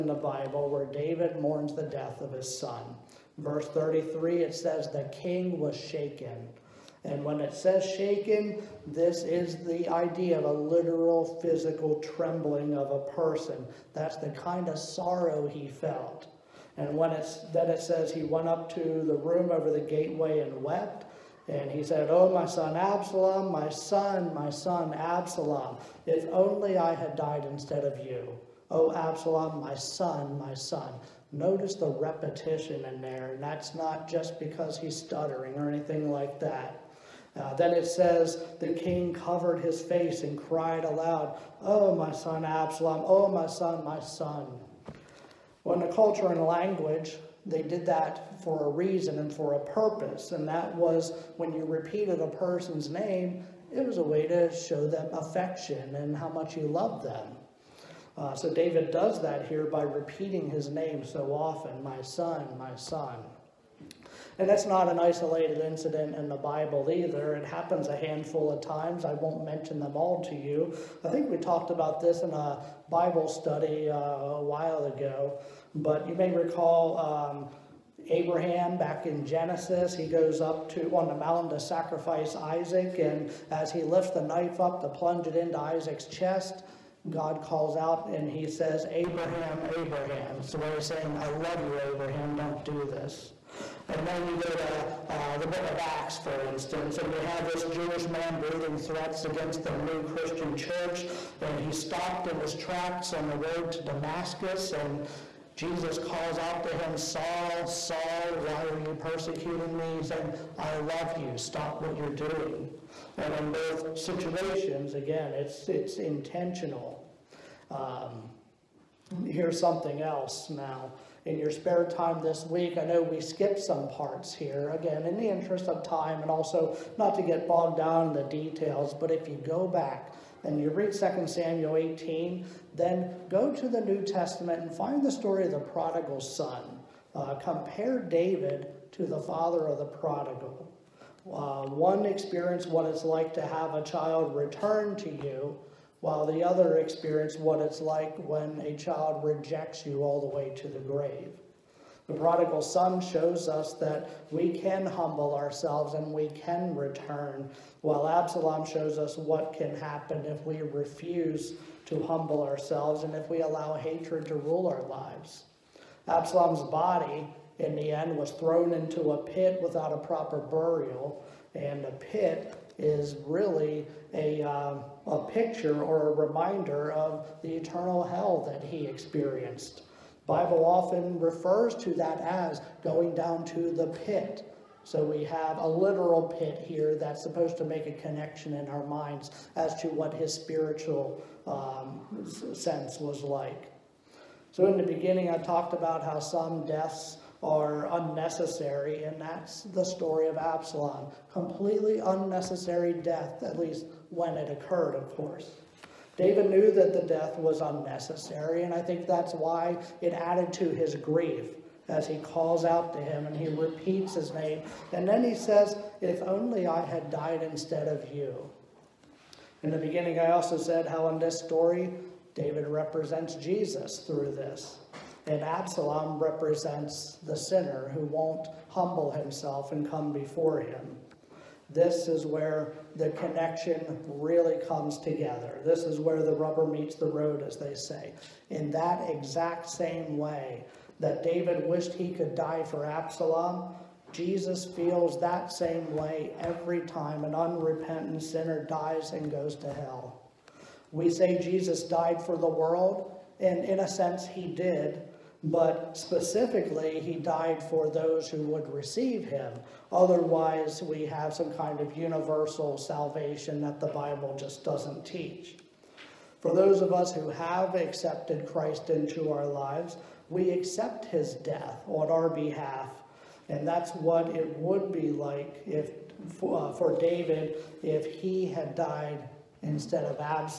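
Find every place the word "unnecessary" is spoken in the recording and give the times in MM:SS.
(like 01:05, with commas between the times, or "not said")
03:17, 03:21, 03:27.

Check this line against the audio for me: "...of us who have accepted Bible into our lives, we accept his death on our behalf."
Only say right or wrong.
wrong.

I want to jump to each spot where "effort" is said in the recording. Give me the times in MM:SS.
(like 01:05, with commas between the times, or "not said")
not said.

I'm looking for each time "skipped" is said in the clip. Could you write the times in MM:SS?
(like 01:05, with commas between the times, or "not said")
02:03.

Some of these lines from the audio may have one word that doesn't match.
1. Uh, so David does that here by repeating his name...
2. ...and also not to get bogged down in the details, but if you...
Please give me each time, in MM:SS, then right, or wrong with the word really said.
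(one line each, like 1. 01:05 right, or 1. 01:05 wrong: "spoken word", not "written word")
1. 00:58 right
2. 02:06 right.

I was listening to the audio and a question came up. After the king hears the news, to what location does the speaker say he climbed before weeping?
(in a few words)
The room over the gateway.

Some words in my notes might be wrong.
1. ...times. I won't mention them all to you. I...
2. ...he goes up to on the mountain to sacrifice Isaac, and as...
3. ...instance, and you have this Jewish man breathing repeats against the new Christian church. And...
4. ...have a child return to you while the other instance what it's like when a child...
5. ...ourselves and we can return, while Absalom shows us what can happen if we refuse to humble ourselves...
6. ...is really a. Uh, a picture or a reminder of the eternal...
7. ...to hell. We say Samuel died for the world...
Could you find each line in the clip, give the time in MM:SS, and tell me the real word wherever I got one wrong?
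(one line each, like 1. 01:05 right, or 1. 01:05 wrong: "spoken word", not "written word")
1. 01:08 right
2. 01:19 right
3. 01:36 wrong: "threats", not "repeats"
4. 02:23 wrong: "experience", not "instance"
5. 02:35 right
6. 02:52 right
7. 04:09 wrong: "Jesus", not "Samuel".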